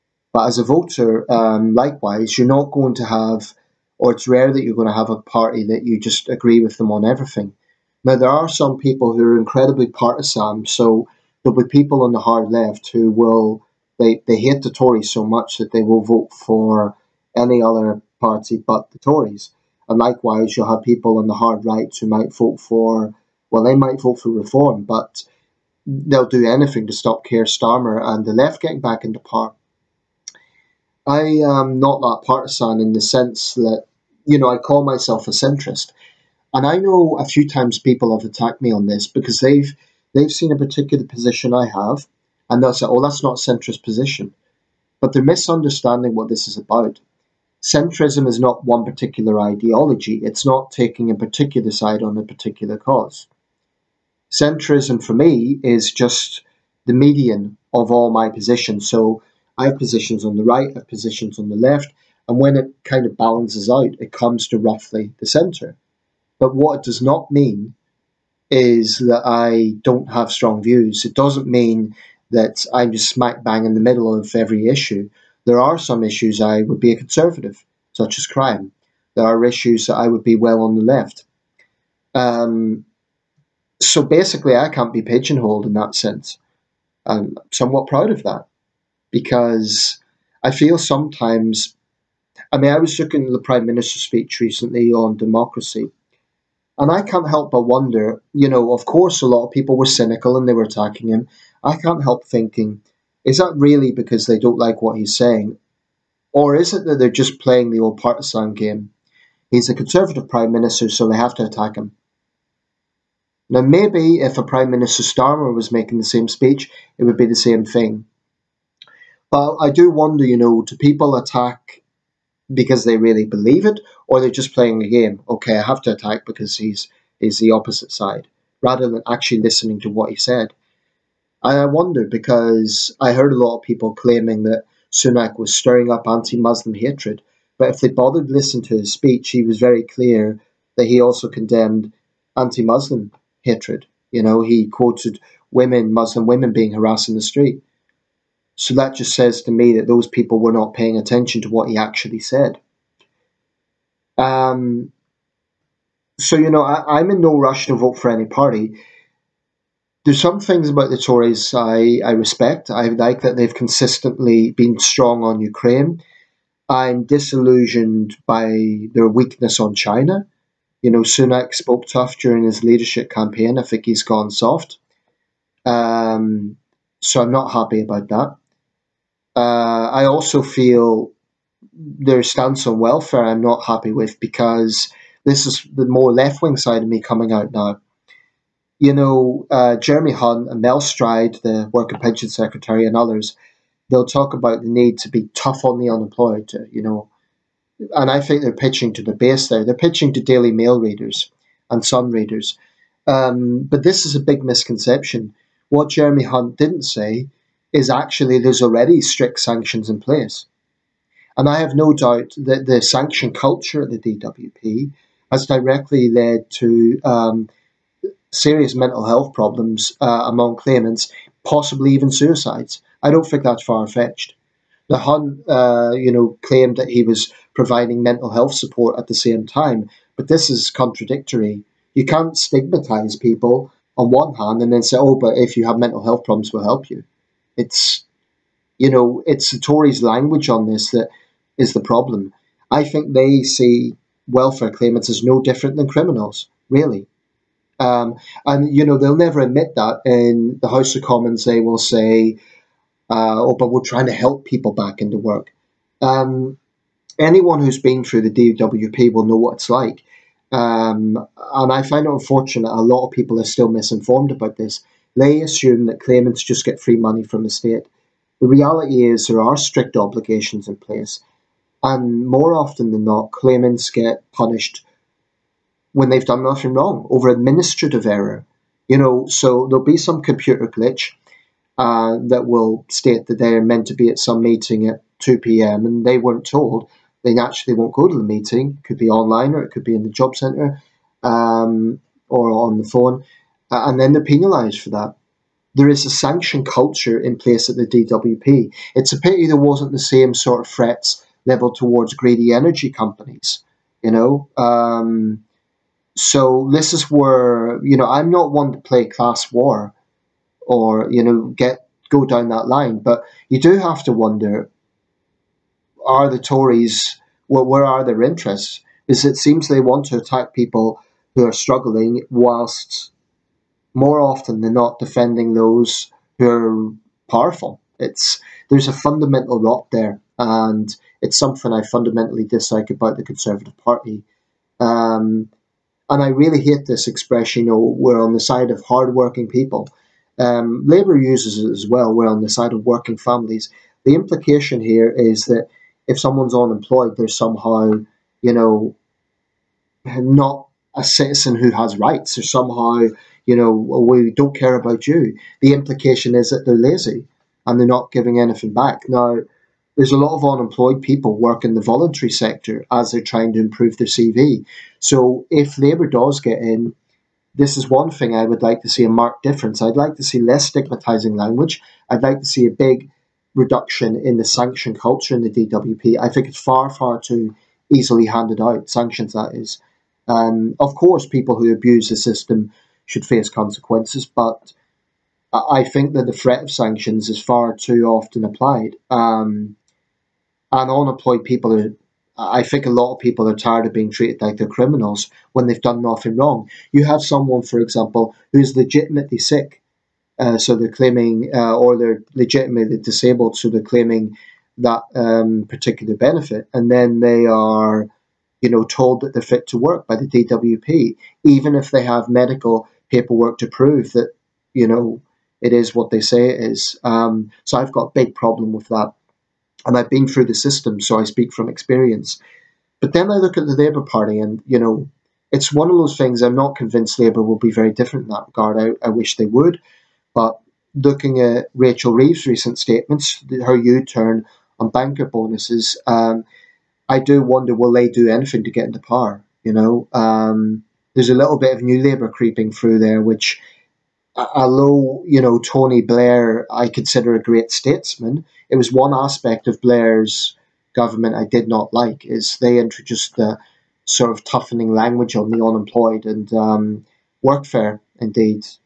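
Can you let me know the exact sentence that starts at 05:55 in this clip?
The implication is that they're lazy and they're not giving anything back.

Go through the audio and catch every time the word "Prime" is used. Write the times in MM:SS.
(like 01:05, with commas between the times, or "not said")
01:33, 01:50, 01:54.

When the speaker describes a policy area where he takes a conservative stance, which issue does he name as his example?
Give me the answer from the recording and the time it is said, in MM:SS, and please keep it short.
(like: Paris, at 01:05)
Crime, at 01:18.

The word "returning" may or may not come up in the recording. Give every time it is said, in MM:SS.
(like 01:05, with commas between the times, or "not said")
not said.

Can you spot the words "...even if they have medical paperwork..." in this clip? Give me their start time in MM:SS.
06:51.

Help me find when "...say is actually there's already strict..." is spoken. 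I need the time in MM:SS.
03:26.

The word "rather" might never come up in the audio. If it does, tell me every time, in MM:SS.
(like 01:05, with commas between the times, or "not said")
02:08.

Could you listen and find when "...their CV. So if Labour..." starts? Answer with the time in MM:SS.
06:03.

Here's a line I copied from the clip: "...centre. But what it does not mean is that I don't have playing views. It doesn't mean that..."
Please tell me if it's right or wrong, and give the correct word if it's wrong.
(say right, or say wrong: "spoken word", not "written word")
wrong: "strong", not "playing".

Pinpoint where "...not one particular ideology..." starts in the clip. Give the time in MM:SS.
00:48.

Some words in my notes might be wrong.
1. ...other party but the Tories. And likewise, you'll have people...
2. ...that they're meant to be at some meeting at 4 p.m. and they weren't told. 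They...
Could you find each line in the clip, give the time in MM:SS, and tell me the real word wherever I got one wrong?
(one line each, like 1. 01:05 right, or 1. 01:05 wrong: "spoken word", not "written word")
1. 00:17 right
2. 04:43 wrong: "2", not "4".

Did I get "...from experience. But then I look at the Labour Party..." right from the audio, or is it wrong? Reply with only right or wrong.
right.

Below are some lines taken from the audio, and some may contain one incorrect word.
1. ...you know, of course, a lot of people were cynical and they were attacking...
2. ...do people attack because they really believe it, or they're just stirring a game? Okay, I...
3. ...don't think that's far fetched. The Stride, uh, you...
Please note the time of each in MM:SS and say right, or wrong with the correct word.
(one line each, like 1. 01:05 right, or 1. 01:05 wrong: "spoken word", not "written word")
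1. 01:38 right
2. 02:00 wrong: "playing", not "stirring"
3. 03:43 wrong: "Hun", not "Stride".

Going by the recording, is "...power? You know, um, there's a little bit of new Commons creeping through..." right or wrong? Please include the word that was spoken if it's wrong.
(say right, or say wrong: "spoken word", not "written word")
wrong: "Labour", not "Commons".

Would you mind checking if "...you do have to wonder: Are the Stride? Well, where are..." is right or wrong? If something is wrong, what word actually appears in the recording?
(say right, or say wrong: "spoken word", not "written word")
wrong: "Tories", not "Stride".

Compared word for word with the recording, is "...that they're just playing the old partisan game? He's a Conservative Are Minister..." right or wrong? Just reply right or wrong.
wrong.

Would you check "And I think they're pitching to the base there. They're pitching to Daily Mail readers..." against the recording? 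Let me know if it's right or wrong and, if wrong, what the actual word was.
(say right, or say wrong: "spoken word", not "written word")
right.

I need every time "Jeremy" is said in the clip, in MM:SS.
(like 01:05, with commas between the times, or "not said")
03:09, 03:25.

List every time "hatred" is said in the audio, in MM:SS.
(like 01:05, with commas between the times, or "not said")
02:16, 02:23.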